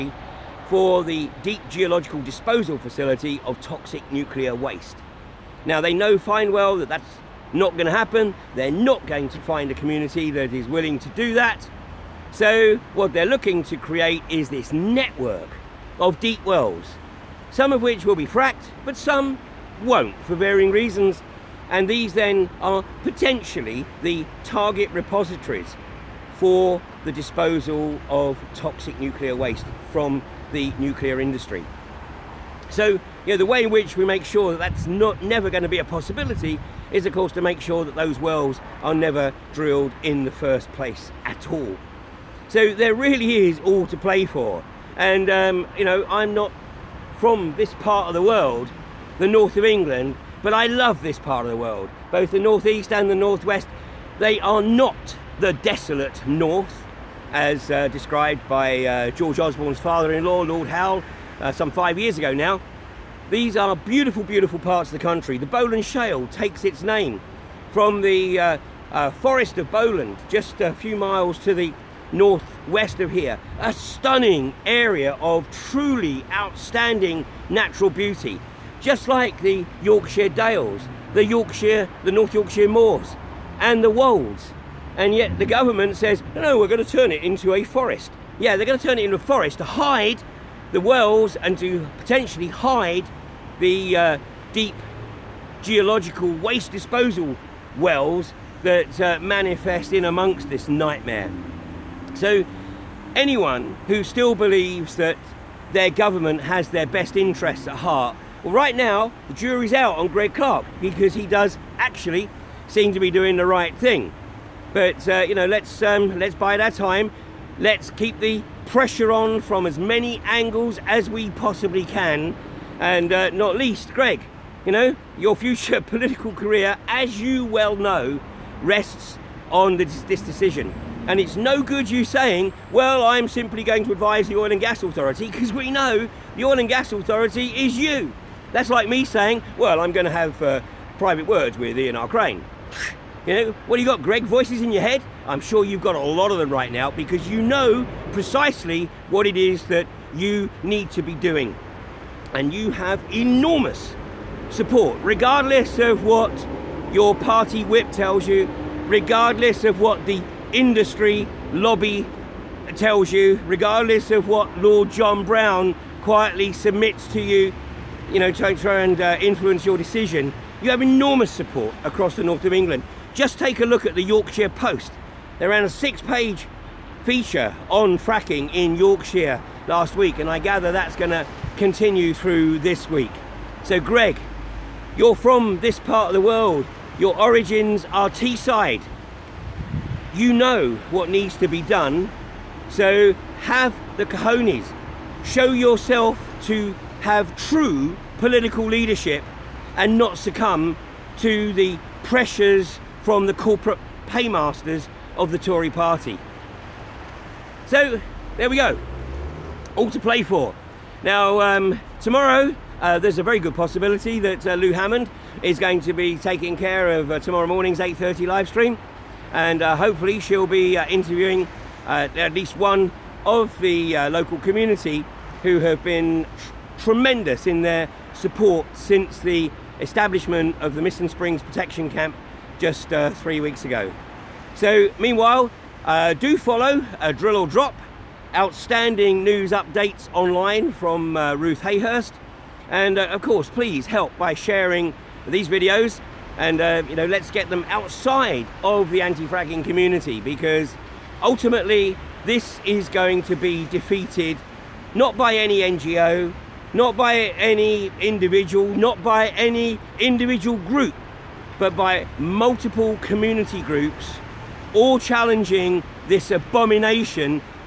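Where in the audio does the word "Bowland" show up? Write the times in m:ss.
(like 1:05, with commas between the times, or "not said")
1:05, 1:09.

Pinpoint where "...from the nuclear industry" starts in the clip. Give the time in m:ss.
0:29.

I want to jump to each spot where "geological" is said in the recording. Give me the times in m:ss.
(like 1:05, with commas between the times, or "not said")
0:01, 1:35.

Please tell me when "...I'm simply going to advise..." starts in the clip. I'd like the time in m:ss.
2:13.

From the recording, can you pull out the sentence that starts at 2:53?
Just take a look at the Yorkshire Post.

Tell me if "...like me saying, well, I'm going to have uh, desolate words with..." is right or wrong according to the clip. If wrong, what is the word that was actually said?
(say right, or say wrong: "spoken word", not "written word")
wrong: "private", not "desolate".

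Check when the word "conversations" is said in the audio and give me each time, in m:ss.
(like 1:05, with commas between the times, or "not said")
not said.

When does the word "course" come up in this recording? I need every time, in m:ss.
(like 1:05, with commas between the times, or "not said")
0:37, 4:03.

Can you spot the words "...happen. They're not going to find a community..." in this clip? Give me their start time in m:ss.
0:07.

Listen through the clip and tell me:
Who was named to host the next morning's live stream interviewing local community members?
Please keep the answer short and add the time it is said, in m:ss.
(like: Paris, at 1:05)
Lou Hammond, at 3:34.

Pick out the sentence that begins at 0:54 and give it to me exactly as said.
They are not the desolate north as uh, described by uh, George Osborne's father-in-law, Lord Howell, uh, some five years ago now.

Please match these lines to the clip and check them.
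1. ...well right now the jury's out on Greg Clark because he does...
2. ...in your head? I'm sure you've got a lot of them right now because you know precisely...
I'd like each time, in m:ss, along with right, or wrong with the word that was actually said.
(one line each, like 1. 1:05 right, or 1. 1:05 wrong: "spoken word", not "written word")
1. 1:48 right
2. 2:24 right.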